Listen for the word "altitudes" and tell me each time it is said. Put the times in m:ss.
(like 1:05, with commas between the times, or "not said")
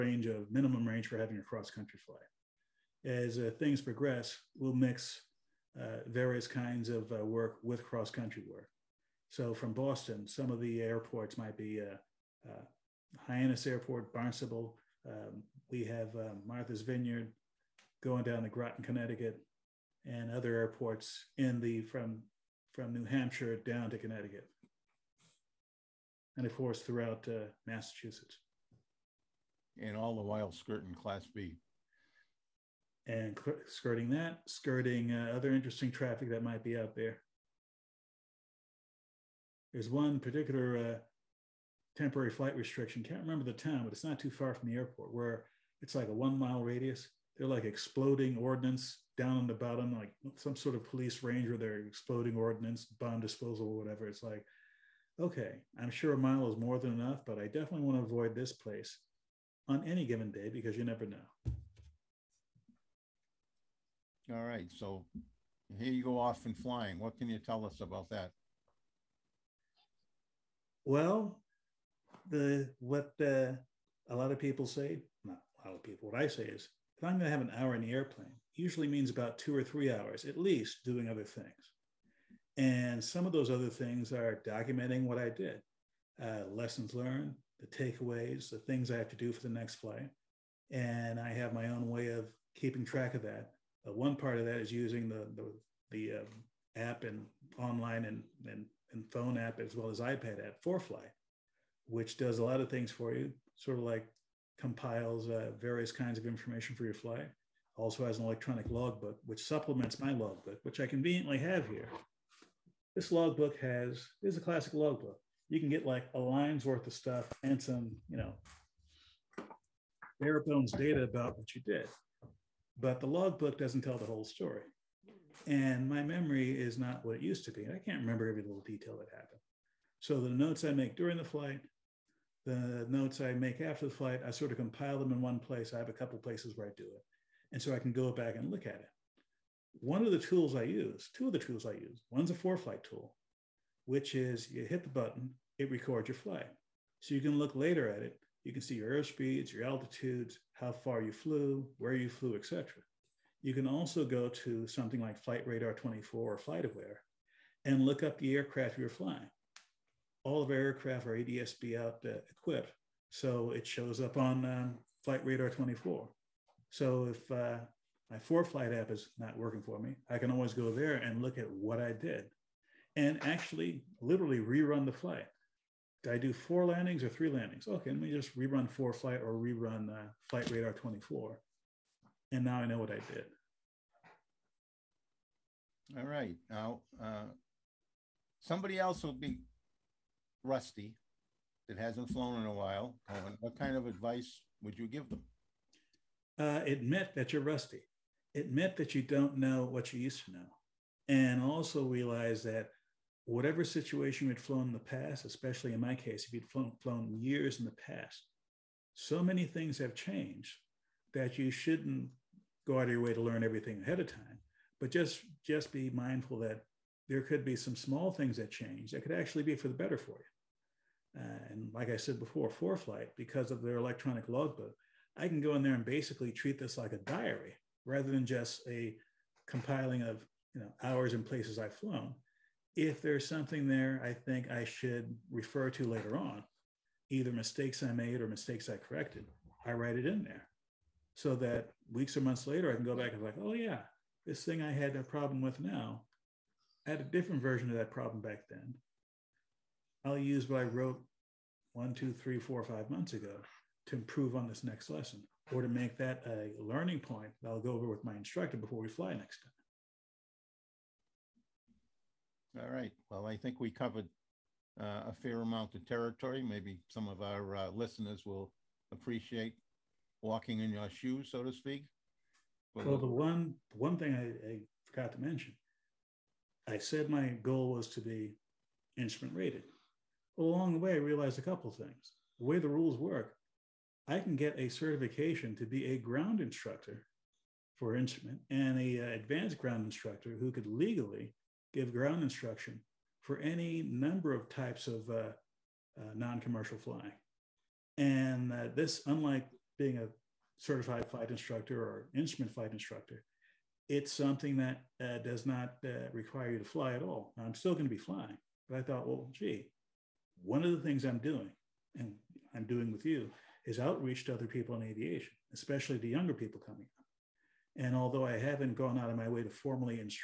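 2:29.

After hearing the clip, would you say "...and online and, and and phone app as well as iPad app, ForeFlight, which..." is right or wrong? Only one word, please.
right.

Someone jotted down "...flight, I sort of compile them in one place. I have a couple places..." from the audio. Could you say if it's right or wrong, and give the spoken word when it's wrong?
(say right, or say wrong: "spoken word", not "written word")
right.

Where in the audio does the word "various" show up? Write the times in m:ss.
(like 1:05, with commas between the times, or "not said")
0:06, 1:45.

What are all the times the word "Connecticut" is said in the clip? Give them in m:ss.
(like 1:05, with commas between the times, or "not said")
0:18, 0:23.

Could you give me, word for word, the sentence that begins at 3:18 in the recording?
Admit that you don't know what you used to know.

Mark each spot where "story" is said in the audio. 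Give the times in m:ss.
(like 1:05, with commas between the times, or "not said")
2:04.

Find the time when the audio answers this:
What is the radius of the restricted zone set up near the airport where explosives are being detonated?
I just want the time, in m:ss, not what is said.
0:46.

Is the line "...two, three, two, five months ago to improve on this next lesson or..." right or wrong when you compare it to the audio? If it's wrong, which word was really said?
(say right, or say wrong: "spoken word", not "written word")
wrong: "four", not "two".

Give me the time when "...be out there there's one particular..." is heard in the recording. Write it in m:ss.
0:36.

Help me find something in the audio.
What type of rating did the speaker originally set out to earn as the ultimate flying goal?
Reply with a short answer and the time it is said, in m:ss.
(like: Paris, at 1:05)
Instrument rated, at 4:38.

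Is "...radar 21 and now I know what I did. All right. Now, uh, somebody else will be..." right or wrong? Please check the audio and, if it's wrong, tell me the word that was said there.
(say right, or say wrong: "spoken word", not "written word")
wrong: "24", not "21".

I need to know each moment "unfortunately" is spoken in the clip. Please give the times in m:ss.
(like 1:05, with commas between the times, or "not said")
not said.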